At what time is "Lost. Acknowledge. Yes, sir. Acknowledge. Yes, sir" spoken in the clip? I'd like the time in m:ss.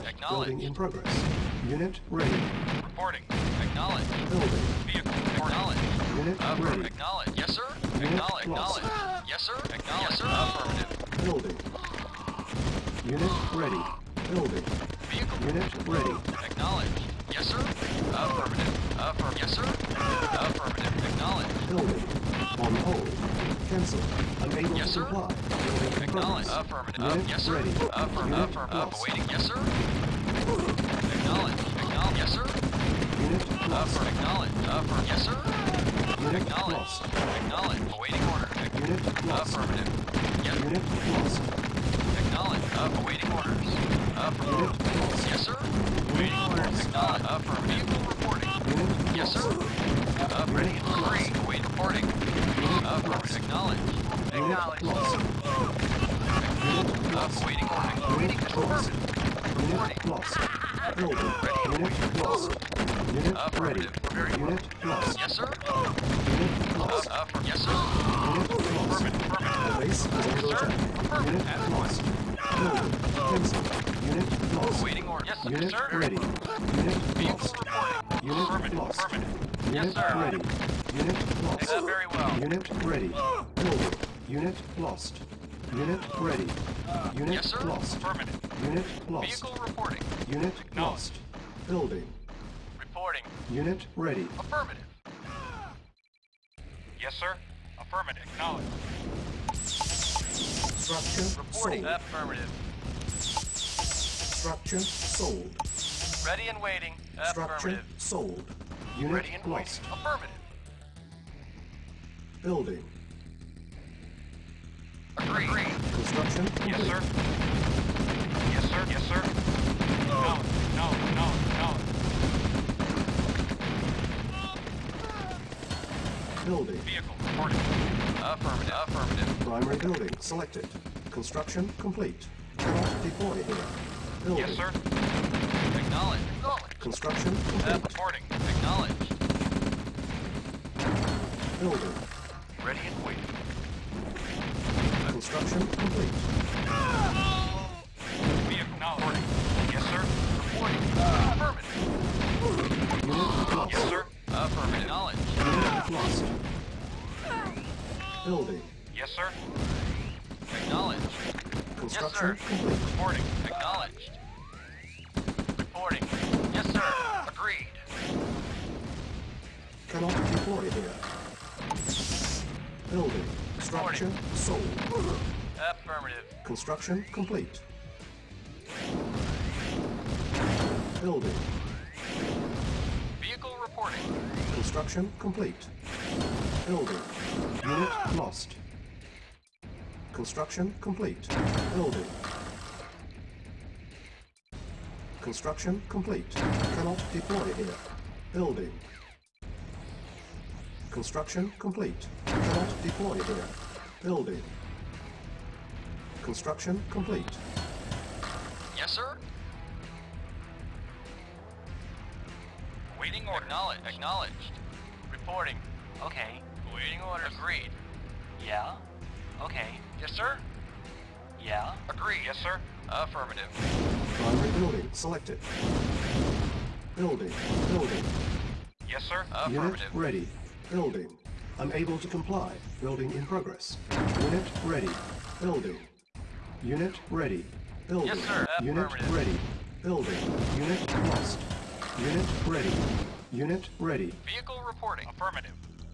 0:08.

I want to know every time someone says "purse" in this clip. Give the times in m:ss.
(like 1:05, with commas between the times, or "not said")
not said.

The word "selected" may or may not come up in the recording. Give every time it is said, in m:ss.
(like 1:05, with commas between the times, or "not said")
2:10, 3:44.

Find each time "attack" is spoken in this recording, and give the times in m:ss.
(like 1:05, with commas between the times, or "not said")
1:10.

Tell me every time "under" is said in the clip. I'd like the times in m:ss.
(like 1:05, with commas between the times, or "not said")
1:10.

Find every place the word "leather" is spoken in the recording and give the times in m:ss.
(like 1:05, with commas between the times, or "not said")
not said.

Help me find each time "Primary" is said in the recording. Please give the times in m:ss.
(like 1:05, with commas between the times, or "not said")
2:09, 3:44.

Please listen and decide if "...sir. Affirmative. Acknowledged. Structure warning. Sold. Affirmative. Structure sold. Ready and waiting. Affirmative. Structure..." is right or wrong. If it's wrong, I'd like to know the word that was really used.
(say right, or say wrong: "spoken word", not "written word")
wrong: "reporting", not "warning".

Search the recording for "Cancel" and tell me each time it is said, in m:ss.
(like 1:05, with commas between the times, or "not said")
0:23, 1:13.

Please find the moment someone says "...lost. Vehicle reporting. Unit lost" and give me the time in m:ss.
1:29.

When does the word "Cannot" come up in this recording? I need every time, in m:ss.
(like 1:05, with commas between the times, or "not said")
2:12, 2:49, 3:16, 3:22.